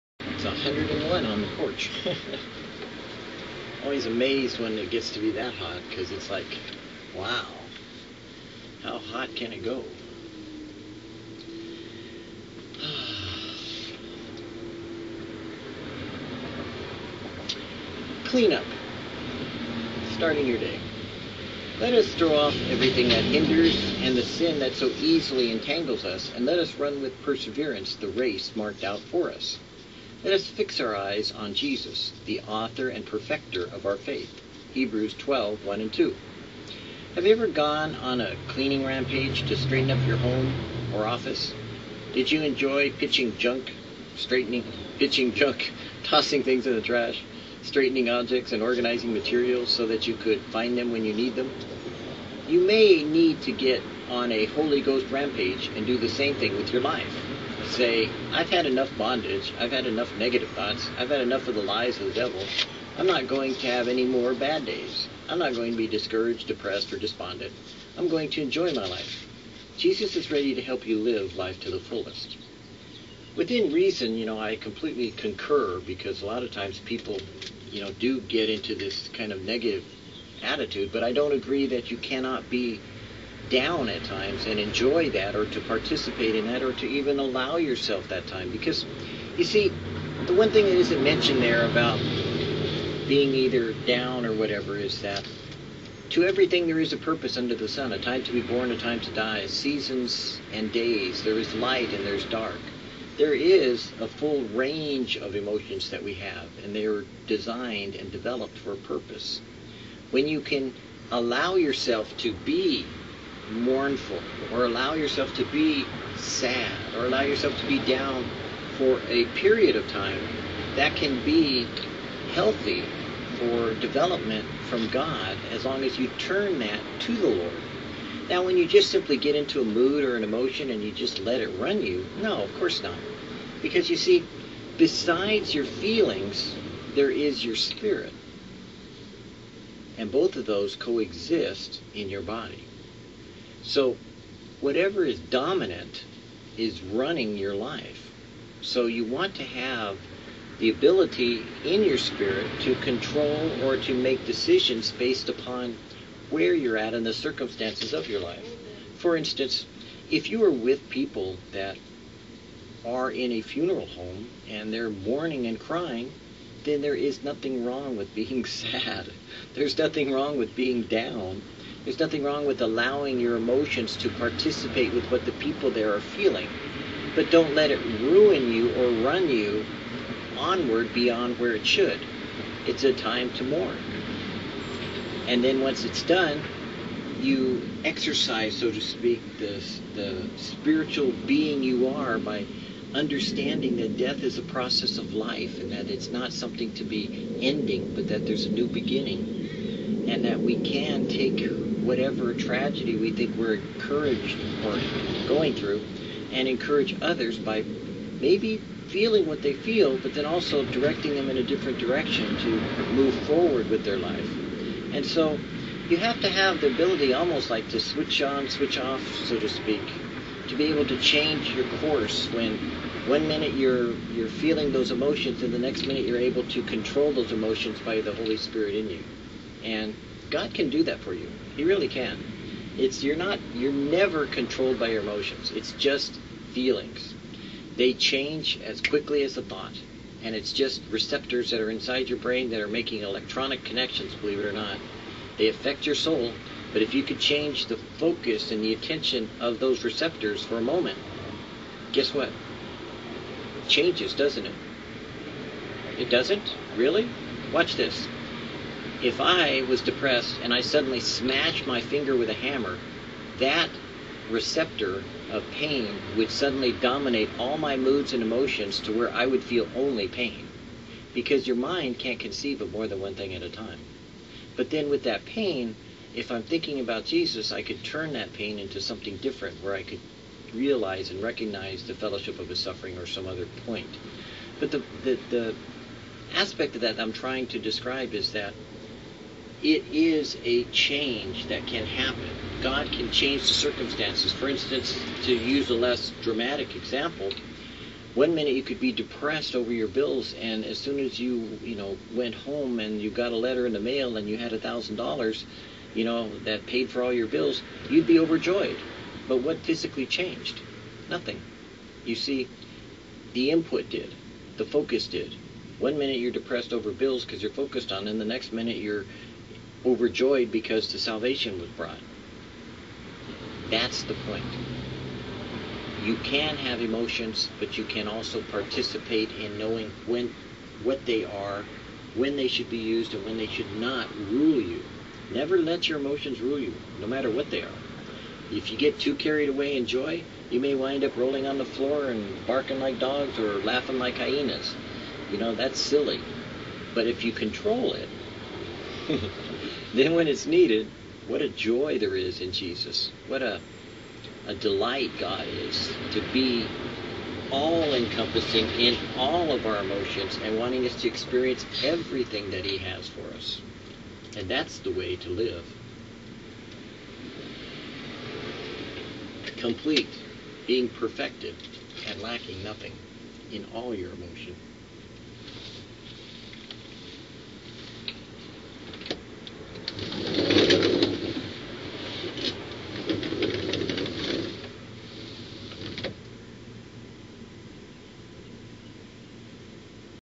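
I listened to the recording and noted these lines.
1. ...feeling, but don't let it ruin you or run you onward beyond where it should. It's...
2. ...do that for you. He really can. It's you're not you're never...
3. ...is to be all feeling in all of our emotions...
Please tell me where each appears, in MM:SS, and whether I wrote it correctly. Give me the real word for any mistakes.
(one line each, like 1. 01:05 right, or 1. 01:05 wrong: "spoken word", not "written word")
1. 02:55 right
2. 03:50 right
3. 05:55 wrong: "encompassing", not "feeling".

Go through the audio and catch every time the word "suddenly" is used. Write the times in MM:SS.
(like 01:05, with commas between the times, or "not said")
04:20, 04:26.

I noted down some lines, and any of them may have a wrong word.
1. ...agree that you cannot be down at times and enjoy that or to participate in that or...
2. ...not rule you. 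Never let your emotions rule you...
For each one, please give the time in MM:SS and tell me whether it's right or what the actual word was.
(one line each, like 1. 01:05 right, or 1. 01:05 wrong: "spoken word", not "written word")
1. 01:21 right
2. 05:33 right.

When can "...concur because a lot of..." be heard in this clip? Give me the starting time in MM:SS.
01:15.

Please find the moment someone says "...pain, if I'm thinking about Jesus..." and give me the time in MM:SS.
04:35.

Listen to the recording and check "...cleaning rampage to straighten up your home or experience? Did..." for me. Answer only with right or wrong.
wrong.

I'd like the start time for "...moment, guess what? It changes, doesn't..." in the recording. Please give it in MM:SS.
04:10.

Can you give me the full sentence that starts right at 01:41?
There is light and there's dark.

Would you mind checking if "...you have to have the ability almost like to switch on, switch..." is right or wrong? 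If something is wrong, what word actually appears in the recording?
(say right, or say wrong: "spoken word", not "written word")
right.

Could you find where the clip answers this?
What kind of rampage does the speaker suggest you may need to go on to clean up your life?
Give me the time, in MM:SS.
00:54.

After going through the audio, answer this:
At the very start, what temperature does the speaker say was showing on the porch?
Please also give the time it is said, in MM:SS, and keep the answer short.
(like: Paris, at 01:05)
101, at 00:00.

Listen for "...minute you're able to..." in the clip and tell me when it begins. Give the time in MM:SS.
03:45.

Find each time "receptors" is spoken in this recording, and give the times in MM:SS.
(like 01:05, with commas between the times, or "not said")
04:00, 04:09, 04:24.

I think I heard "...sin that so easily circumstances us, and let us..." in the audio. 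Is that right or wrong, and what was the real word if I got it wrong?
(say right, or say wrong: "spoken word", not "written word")
wrong: "entangles", not "circumstances".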